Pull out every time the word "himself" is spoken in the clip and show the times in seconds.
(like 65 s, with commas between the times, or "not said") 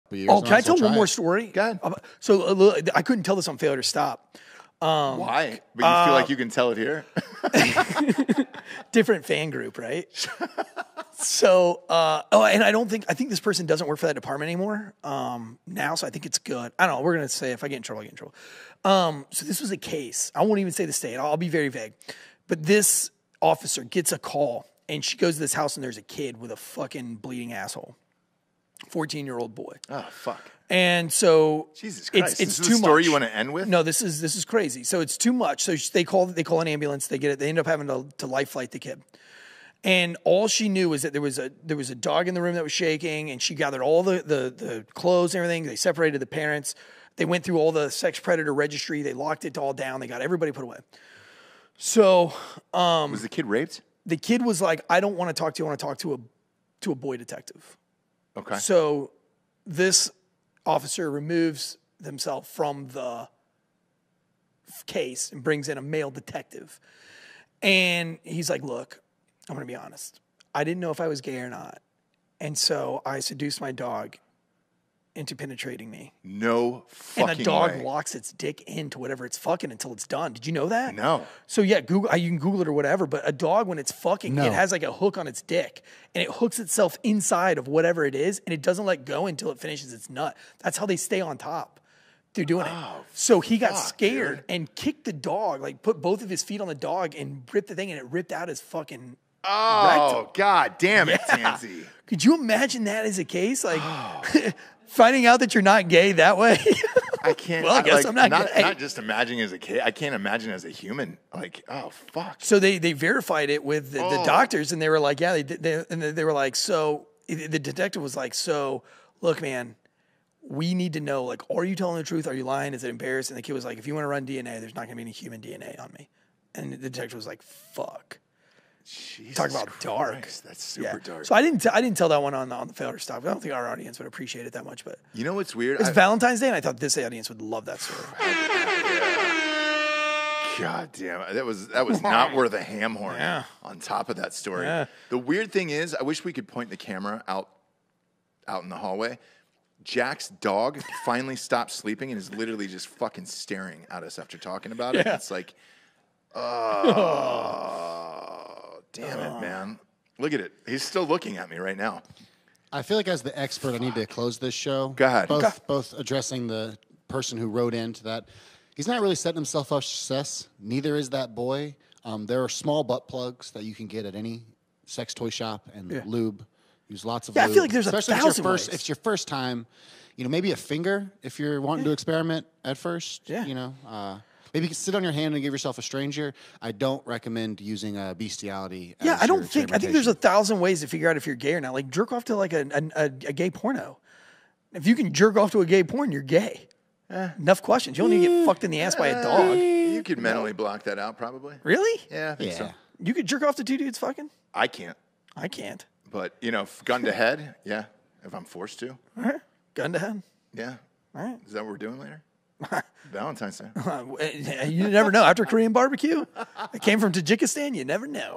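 62 s, 169 s.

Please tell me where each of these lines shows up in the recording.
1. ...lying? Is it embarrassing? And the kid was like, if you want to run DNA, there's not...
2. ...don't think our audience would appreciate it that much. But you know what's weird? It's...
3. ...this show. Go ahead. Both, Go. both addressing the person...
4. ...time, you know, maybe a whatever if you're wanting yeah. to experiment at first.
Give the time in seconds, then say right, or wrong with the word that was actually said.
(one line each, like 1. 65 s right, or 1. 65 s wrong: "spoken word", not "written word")
1. 122 s right
2. 133 s right
3. 164 s right
4. 179 s wrong: "finger", not "whatever".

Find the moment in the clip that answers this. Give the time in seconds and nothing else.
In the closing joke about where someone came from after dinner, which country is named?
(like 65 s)
217 s.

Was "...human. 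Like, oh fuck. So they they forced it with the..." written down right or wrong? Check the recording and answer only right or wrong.
wrong.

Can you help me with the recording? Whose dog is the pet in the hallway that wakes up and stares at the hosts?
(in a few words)
Jack.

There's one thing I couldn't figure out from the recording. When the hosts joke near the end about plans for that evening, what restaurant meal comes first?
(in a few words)
Korean barbecue.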